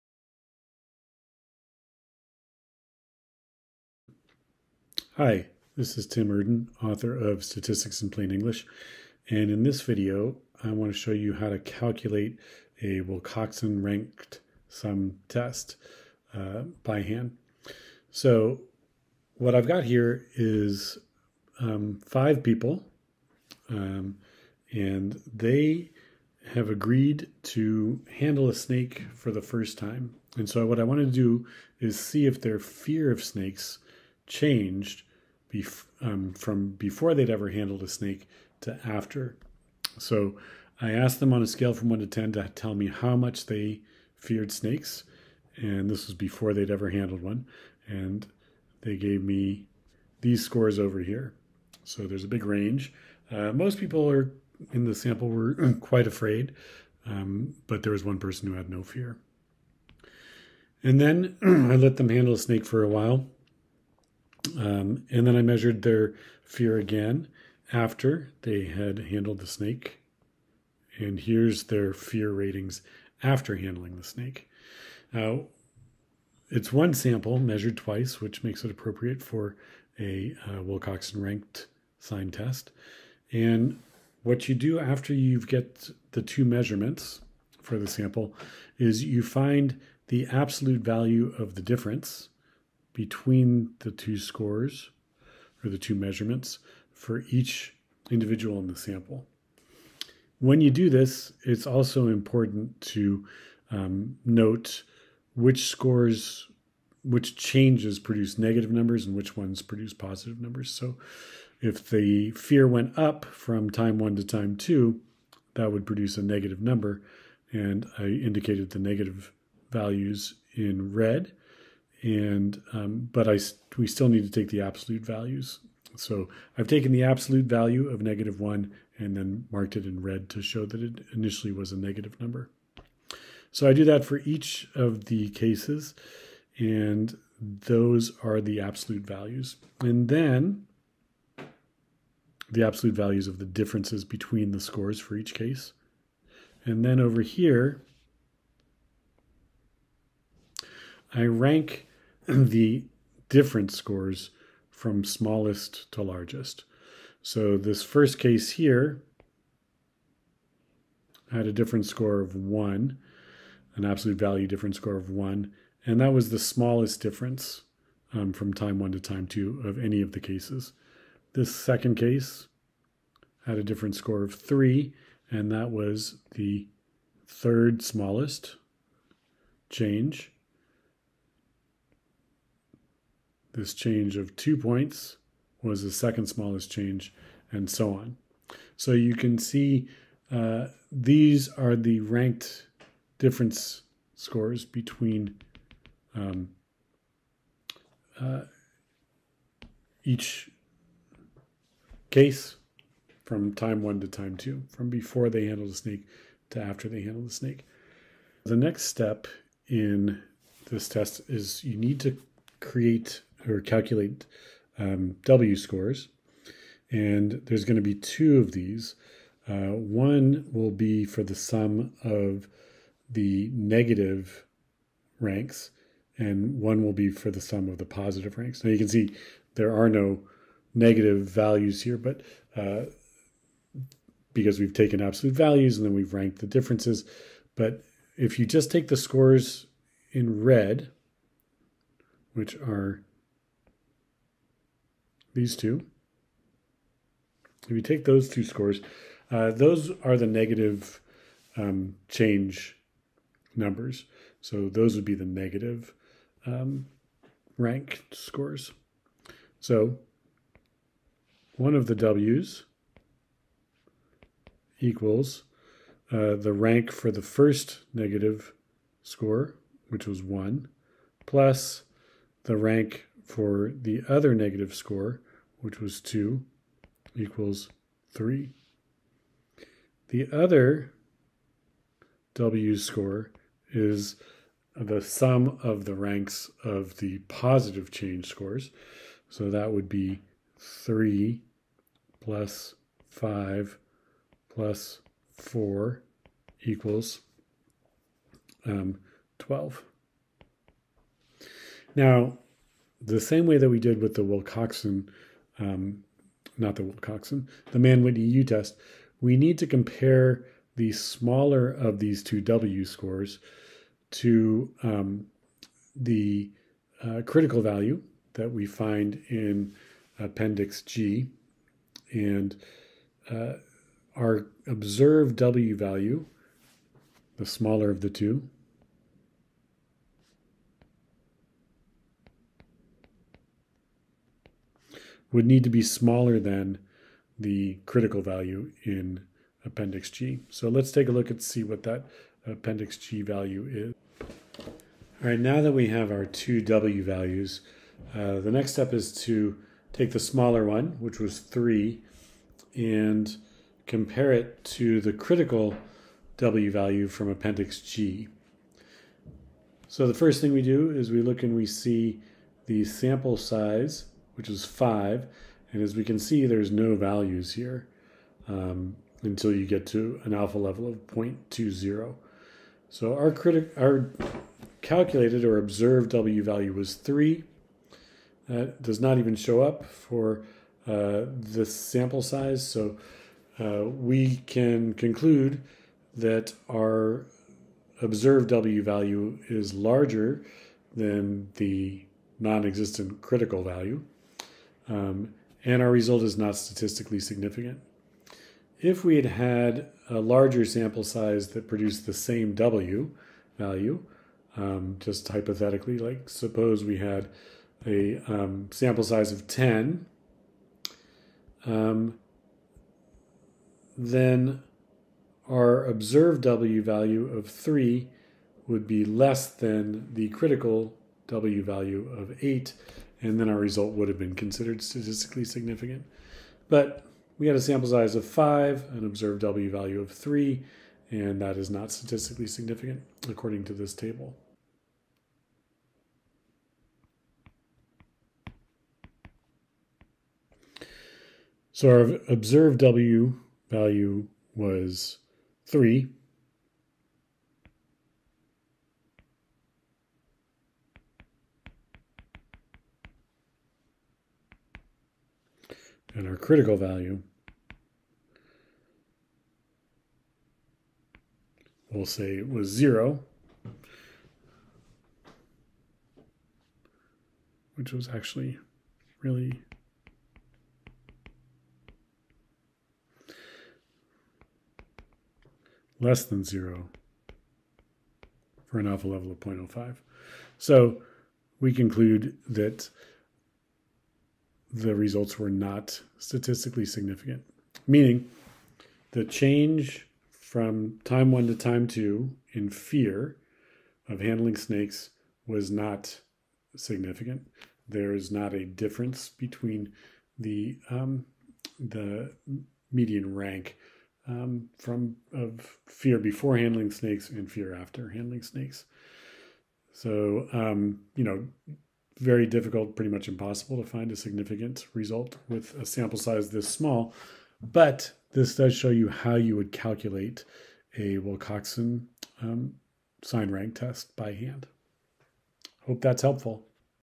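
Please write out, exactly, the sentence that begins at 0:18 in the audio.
So what I've got here is um, five people, um, and they have agreed to handle a snake for the first time.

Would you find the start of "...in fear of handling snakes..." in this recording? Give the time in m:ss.
8:12.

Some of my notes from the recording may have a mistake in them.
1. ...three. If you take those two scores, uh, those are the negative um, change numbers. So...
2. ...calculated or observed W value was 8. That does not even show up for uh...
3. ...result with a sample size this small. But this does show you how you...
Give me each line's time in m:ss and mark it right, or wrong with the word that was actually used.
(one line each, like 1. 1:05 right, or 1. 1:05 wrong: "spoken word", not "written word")
1. 4:05 wrong: "two", not "three"
2. 6:14 wrong: "3", not "8"
3. 8:34 right.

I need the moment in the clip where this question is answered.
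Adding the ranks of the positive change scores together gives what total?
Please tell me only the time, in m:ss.
4:59.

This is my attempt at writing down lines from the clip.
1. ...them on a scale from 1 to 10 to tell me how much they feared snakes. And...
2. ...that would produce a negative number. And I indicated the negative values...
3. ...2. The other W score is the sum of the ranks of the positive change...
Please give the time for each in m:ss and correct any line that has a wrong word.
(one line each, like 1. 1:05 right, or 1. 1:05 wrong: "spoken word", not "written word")
1. 0:41 right
2. 1:55 right
3. 4:38 wrong: "3", not "2".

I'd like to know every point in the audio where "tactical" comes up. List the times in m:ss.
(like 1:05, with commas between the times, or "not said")
not said.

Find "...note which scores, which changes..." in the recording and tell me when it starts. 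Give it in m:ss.
1:44.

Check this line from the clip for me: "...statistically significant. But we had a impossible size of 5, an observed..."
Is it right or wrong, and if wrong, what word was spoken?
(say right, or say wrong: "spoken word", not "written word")
wrong: "sample", not "impossible".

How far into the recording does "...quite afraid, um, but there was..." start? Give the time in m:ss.
0:55.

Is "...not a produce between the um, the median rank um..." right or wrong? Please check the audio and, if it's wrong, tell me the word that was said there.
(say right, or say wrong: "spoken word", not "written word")
wrong: "difference", not "produce".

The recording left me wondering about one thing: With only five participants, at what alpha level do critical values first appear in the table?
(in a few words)
0.20.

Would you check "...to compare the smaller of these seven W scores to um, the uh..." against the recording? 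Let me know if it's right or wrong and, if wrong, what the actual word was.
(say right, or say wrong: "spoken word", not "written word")
wrong: "two", not "seven".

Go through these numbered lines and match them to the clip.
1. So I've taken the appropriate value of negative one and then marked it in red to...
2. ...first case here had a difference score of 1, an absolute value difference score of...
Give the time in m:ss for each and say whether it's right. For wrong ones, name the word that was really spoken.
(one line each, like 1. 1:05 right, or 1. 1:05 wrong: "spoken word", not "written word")
1. 2:05 wrong: "absolute", not "appropriate"
2. 2:37 right.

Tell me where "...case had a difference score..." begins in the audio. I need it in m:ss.
2:51.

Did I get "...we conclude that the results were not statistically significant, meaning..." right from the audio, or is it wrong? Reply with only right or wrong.
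right.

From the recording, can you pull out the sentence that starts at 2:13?
So I do that for each of the cases, and those are the absolute values.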